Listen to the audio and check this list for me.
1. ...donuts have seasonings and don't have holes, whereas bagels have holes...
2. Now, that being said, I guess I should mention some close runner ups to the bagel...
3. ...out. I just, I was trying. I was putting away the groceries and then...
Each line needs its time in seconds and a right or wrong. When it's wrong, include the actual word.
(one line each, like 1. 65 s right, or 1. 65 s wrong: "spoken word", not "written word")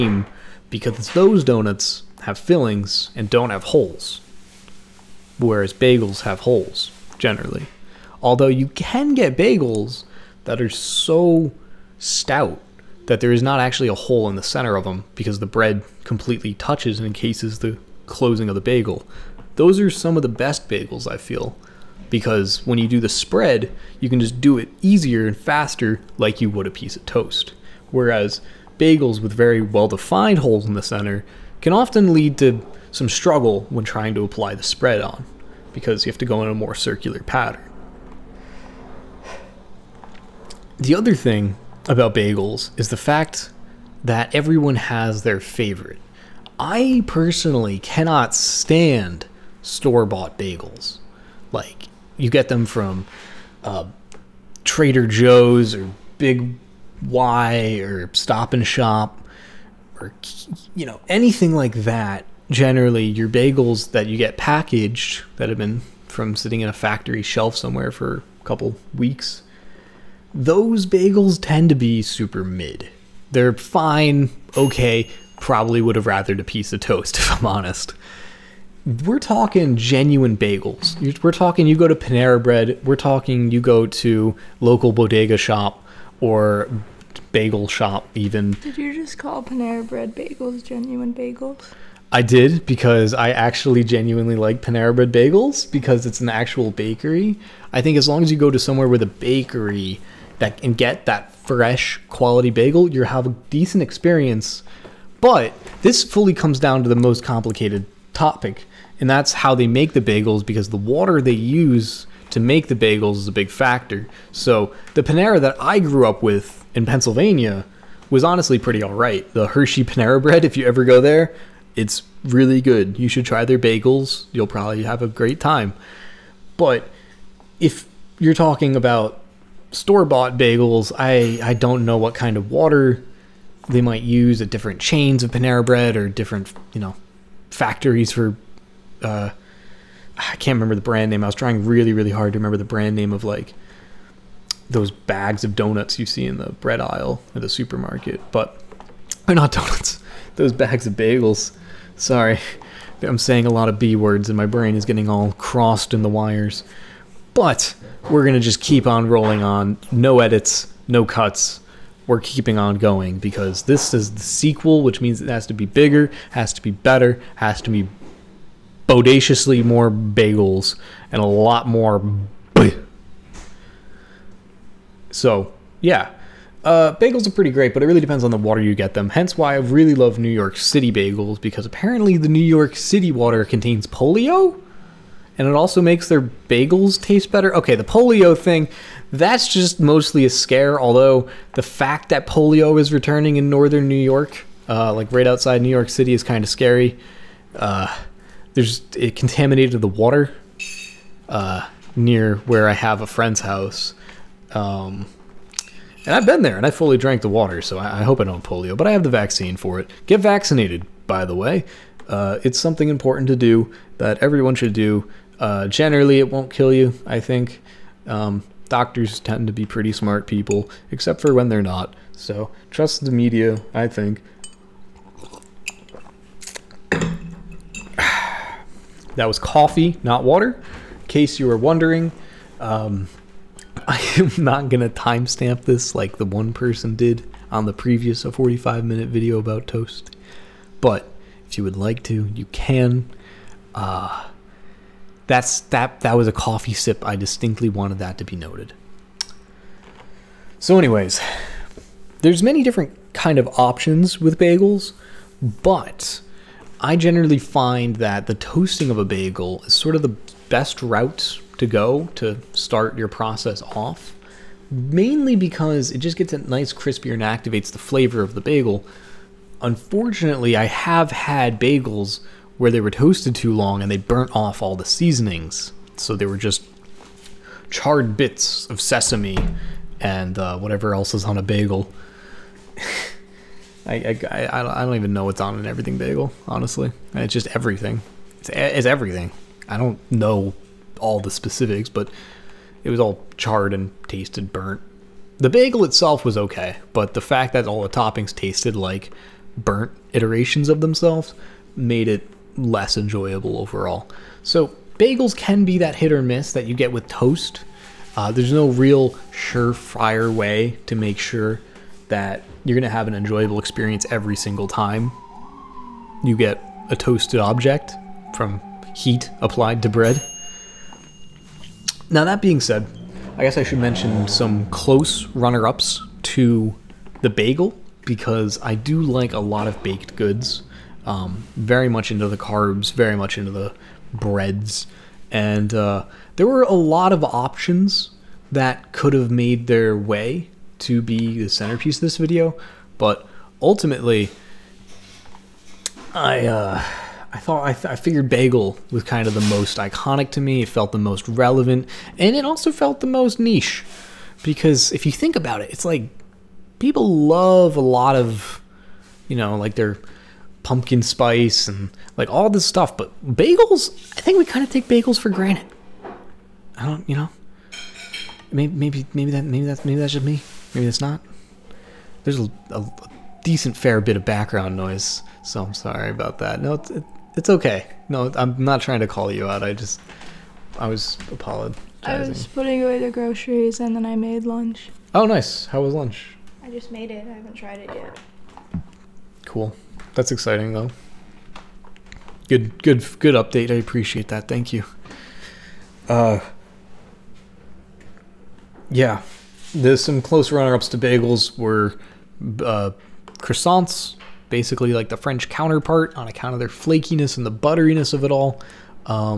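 1. 1 s wrong: "fillings", not "seasonings"
2. 322 s right
3. 379 s wrong: "apologizing", not "trying".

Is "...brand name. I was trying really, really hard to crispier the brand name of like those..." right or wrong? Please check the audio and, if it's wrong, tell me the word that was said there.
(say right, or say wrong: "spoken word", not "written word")
wrong: "remember", not "crispier".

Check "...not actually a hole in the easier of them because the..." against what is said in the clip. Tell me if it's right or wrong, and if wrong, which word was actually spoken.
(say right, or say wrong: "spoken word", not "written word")
wrong: "center", not "easier".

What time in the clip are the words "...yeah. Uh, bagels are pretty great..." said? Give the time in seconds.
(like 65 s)
175 s.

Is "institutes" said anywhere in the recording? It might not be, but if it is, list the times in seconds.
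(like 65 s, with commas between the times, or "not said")
not said.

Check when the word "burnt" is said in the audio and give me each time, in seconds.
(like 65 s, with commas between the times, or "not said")
273 s, 294 s, 299 s.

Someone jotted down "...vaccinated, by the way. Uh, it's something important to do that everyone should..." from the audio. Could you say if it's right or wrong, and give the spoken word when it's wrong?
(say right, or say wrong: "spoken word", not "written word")
right.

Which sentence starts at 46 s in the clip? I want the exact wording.
I personally cannot stand store bought bagels.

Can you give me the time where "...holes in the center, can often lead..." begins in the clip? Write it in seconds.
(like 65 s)
30 s.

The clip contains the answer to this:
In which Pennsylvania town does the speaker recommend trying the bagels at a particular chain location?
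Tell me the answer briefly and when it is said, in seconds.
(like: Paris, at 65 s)
Hershey, at 119 s.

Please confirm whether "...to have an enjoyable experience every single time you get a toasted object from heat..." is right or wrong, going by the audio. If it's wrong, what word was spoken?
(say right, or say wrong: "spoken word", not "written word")
right.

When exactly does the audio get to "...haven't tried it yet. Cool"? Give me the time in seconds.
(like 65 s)
387 s.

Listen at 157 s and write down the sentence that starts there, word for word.
But we're going to just keep on rolling on.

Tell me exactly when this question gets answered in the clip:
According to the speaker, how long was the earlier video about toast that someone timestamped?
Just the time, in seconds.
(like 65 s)
238 s.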